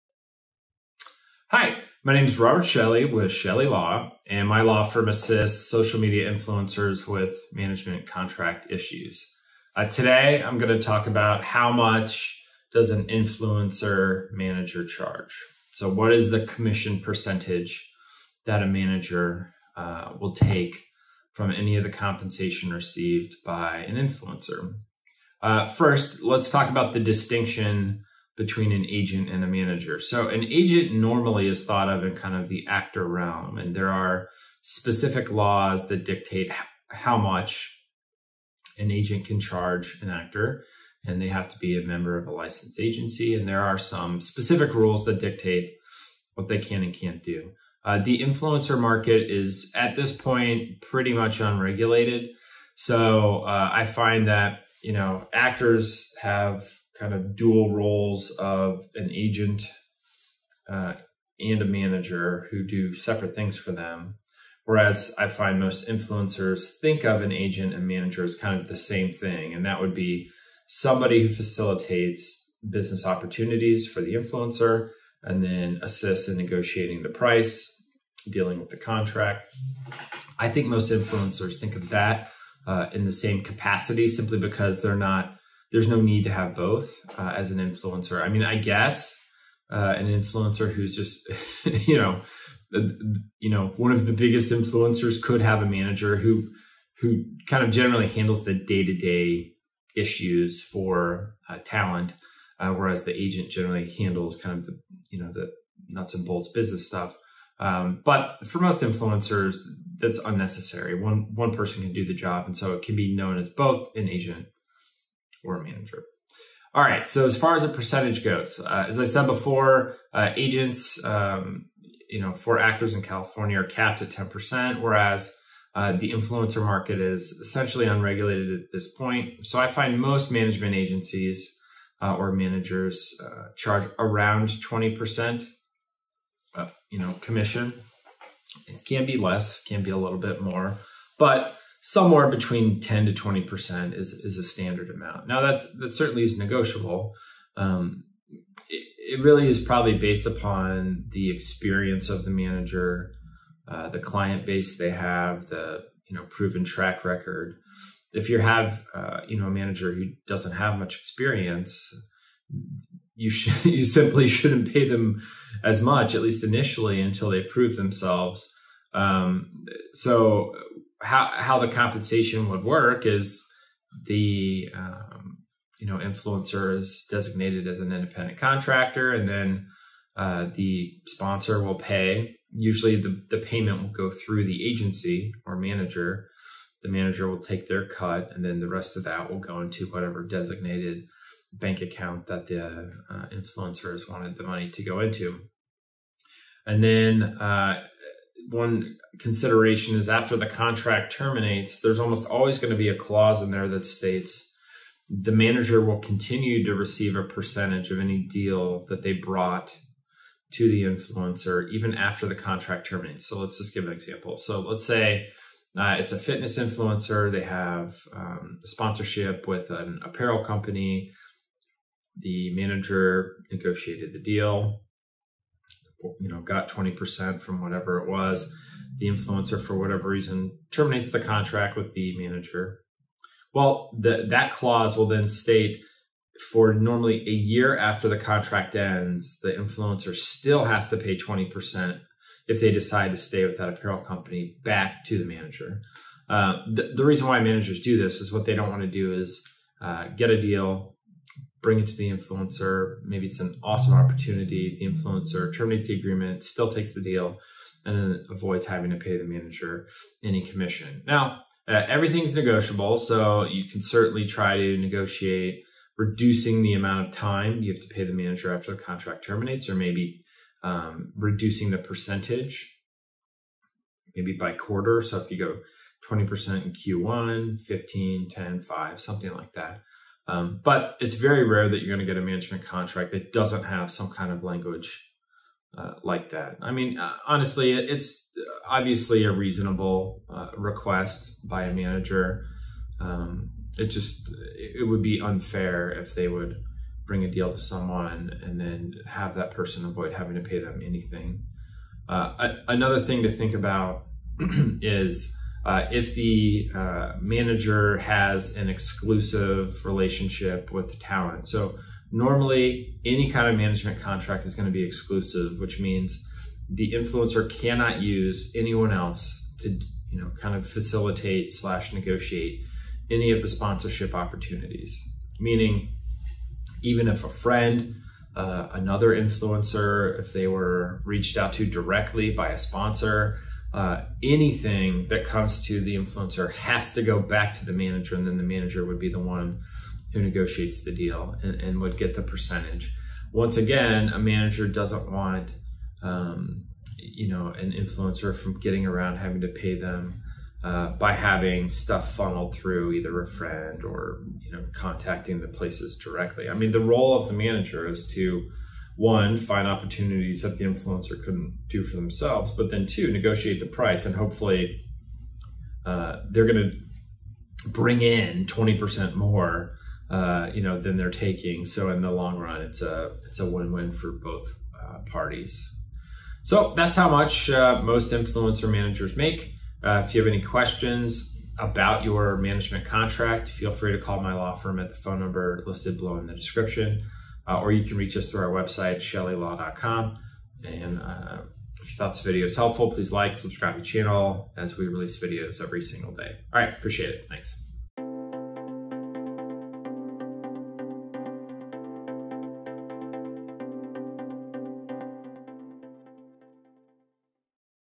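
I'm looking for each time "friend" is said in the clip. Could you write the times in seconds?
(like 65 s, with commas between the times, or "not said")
327 s, 353 s.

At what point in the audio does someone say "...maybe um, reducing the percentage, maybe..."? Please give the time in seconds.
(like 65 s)
269 s.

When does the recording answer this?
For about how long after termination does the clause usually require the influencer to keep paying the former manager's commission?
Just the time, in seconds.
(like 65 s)
237 s.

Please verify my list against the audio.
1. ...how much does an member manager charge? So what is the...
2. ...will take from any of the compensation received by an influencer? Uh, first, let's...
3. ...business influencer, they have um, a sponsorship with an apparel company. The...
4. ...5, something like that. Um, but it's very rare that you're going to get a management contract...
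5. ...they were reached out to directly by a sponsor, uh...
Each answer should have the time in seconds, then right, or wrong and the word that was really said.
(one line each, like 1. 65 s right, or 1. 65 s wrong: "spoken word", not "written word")
1. 11 s wrong: "influencer", not "member"
2. 20 s right
3. 216 s wrong: "fitness", not "business"
4. 278 s right
5. 330 s right.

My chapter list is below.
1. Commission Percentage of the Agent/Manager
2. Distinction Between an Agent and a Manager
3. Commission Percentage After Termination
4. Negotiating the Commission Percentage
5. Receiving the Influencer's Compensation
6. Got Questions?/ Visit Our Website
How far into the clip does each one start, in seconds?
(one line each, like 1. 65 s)
1. 116 s
2. 25 s
3. 213 s
4. 261 s
5. 170 s
6. 376 s.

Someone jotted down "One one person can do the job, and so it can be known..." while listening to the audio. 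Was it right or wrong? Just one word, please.
right.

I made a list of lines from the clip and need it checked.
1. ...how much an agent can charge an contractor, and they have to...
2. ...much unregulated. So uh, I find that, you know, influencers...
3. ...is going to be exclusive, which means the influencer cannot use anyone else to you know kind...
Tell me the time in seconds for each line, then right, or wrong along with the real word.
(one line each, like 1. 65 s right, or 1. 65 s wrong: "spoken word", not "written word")
1. 36 s wrong: "actor", not "contractor"
2. 51 s wrong: "actors", not "influencers"
3. 314 s right.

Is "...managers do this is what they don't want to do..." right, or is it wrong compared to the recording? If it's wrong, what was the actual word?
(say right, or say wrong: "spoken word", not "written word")
right.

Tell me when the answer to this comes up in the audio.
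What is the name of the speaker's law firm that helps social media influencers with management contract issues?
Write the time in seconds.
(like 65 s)
3 s.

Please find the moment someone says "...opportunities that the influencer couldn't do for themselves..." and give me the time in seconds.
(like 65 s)
359 s.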